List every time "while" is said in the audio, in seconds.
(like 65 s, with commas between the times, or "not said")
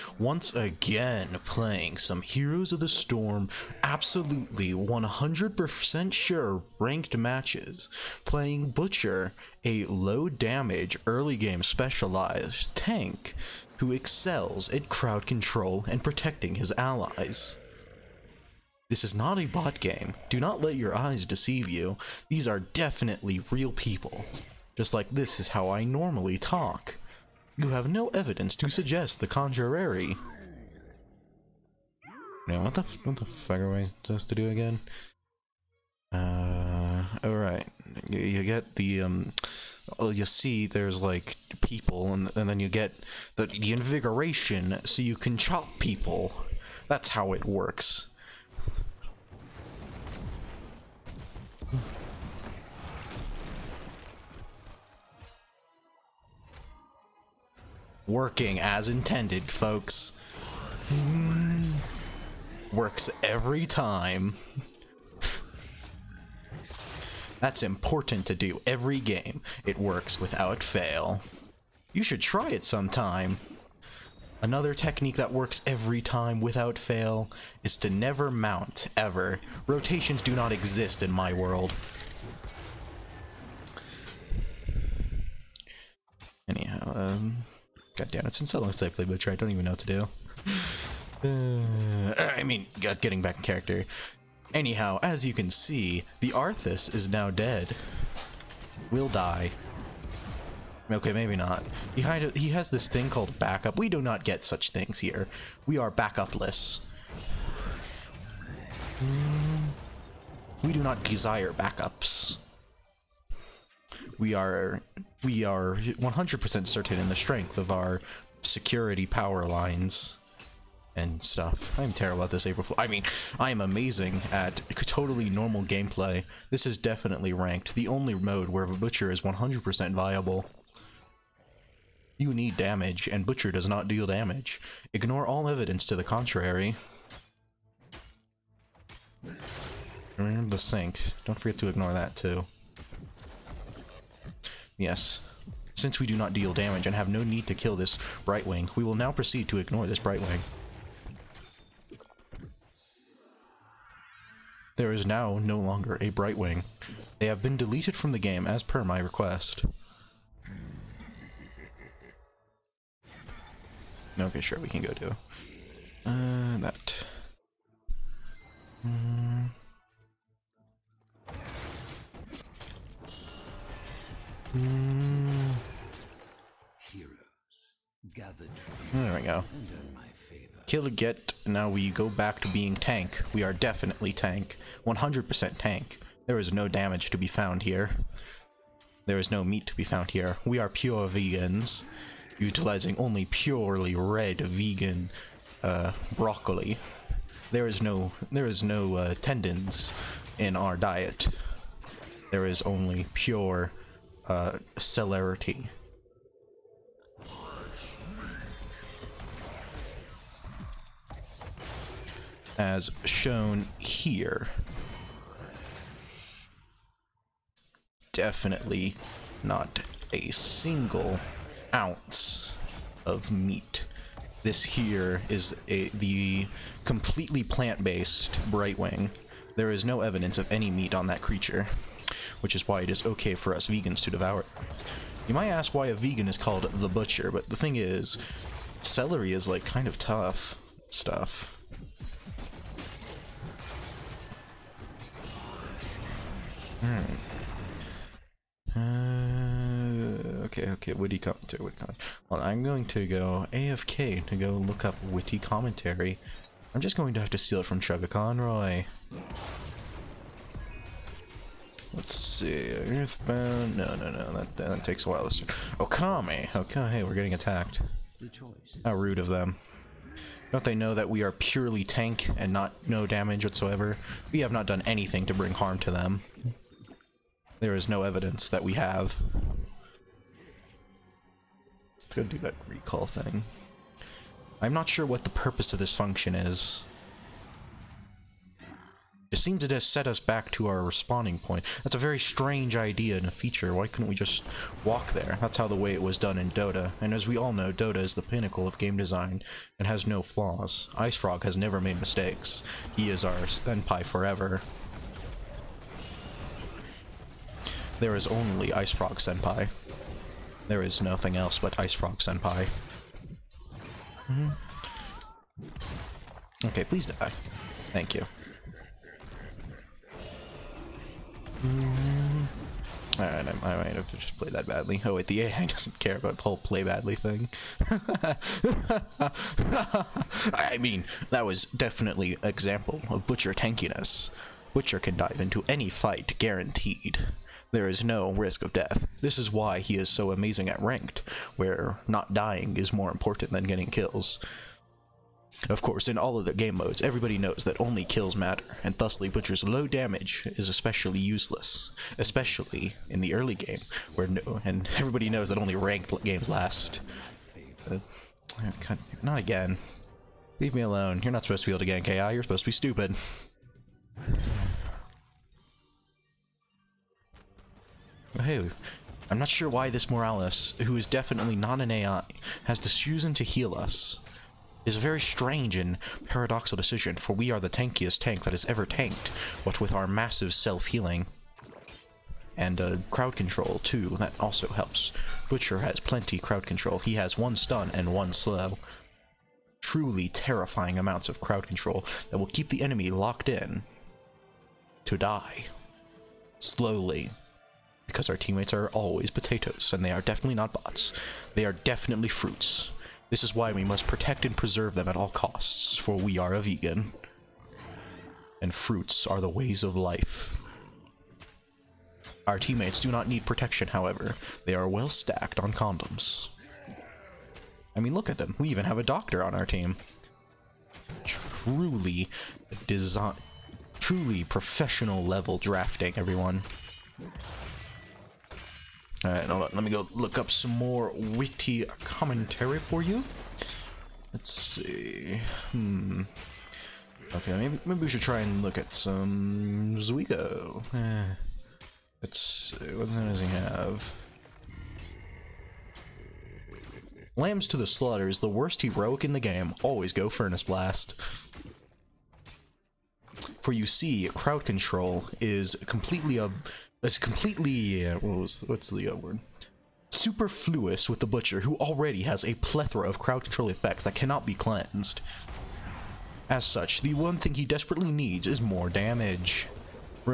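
265 s.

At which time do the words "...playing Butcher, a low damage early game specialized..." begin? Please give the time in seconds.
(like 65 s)
8 s.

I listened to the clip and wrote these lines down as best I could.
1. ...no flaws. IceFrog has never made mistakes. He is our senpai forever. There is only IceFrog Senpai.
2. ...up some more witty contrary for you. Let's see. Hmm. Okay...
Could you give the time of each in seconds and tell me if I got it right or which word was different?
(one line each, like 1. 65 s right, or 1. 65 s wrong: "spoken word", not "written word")
1. 300 s right
2. 430 s wrong: "commentary", not "contrary".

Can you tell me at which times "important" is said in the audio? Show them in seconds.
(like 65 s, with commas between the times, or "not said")
67 s, 343 s.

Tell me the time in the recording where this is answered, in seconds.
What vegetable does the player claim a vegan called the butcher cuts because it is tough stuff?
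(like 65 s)
238 s.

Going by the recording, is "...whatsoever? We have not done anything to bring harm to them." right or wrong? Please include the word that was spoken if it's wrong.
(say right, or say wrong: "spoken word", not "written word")
right.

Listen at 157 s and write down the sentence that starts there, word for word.
They have been deleted from the game as per my request.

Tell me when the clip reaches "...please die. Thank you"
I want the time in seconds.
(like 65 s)
316 s.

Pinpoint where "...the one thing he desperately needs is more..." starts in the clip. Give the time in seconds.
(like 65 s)
467 s.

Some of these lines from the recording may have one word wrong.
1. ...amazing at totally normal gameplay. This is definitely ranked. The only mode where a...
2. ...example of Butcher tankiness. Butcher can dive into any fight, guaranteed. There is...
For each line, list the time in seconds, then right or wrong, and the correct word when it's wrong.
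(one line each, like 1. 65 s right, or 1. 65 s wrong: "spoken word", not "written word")
1. 123 s right
2. 332 s right.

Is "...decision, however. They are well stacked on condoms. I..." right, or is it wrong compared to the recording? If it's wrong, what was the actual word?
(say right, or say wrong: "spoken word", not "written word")
wrong: "protection", not "decision".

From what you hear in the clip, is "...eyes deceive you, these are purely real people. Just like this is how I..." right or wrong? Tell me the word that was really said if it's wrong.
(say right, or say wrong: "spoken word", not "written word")
wrong: "definitely", not "purely".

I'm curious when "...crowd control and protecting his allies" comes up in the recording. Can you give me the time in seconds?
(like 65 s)
14 s.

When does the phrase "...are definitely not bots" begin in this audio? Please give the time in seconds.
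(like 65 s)
400 s.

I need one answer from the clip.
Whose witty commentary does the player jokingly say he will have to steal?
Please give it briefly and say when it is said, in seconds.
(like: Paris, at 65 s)
ChuggaConroy, at 257 s.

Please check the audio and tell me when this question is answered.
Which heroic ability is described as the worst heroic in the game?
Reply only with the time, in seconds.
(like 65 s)
447 s.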